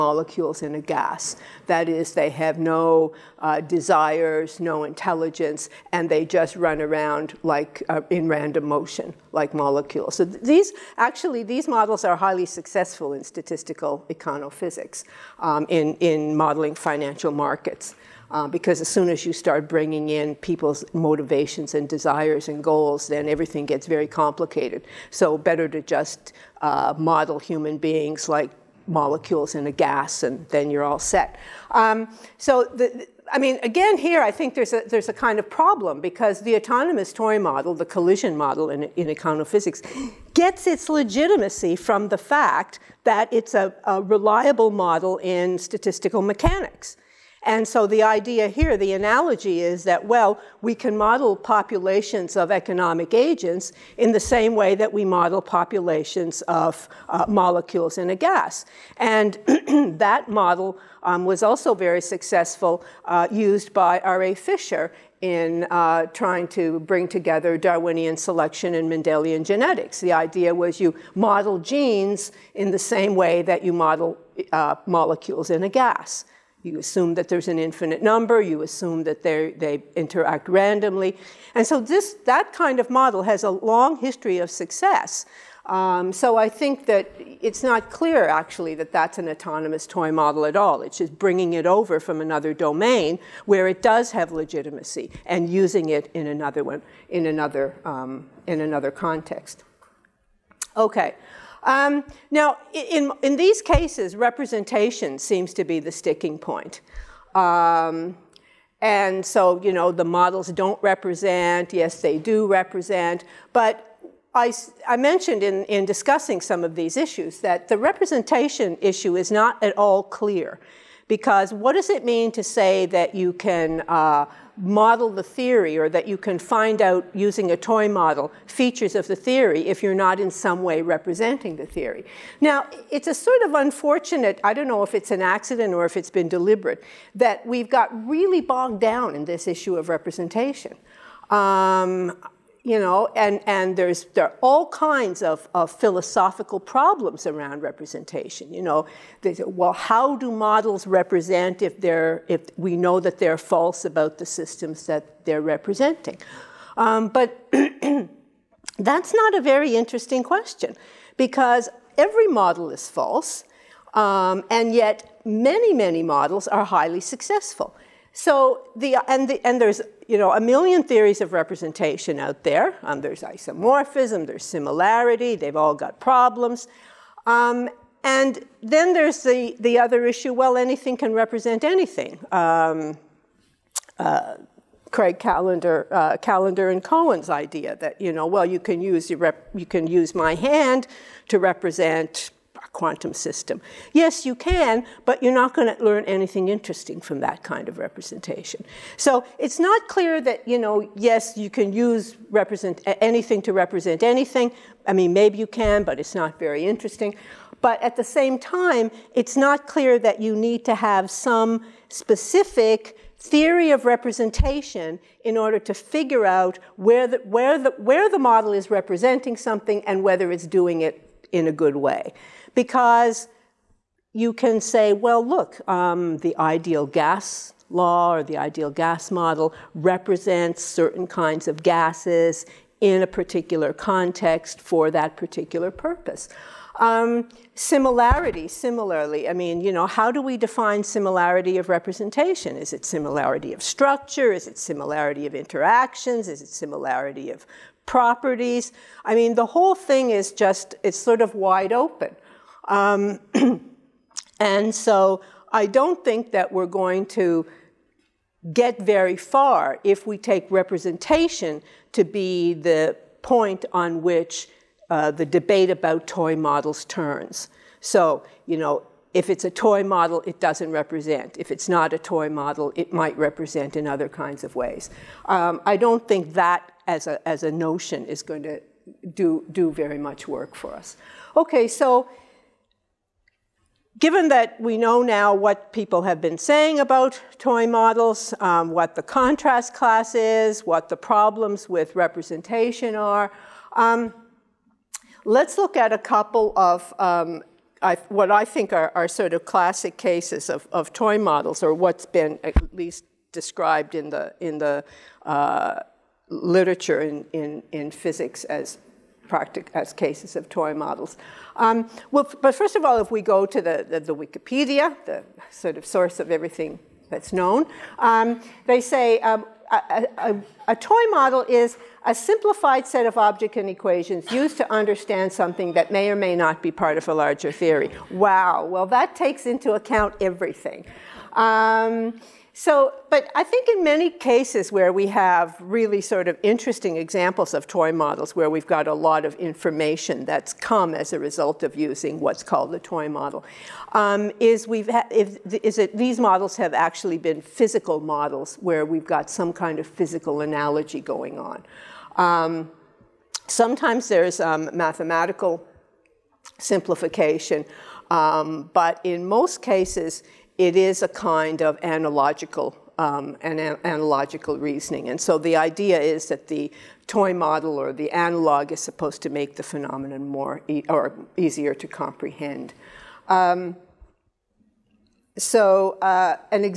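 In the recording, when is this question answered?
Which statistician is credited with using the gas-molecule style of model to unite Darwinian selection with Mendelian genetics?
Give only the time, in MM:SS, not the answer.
01:03.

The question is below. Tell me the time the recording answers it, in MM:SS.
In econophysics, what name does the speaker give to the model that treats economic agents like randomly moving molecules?
00:37.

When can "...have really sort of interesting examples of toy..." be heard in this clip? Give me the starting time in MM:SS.
05:35.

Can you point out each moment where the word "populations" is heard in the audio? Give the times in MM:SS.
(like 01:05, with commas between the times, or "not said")
00:51, 00:55.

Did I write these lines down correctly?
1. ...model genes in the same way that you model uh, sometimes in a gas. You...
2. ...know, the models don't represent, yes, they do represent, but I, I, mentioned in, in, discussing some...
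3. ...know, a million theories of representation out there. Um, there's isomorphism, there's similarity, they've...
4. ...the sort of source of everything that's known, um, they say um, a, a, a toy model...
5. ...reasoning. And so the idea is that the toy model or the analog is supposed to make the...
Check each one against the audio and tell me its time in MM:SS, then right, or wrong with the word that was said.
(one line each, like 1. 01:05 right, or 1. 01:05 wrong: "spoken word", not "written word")
1. 01:11 wrong: "molecules", not "sometimes"
2. 01:49 right
3. 02:50 right
4. 05:15 right
5. 06:04 right.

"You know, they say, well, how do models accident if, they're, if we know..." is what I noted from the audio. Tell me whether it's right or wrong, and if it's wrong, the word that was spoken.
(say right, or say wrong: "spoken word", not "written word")
wrong: "represent", not "accident".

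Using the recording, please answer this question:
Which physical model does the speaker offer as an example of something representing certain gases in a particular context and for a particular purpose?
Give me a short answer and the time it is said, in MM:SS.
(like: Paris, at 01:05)
ideal gas model, at 03:48.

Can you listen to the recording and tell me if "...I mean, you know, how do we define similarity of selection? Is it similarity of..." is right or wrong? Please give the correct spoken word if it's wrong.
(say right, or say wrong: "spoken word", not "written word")
wrong: "representation", not "selection".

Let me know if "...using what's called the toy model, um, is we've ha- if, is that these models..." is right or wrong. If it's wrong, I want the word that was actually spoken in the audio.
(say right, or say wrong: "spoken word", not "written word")
right.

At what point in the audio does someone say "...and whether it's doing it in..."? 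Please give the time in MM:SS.
03:39.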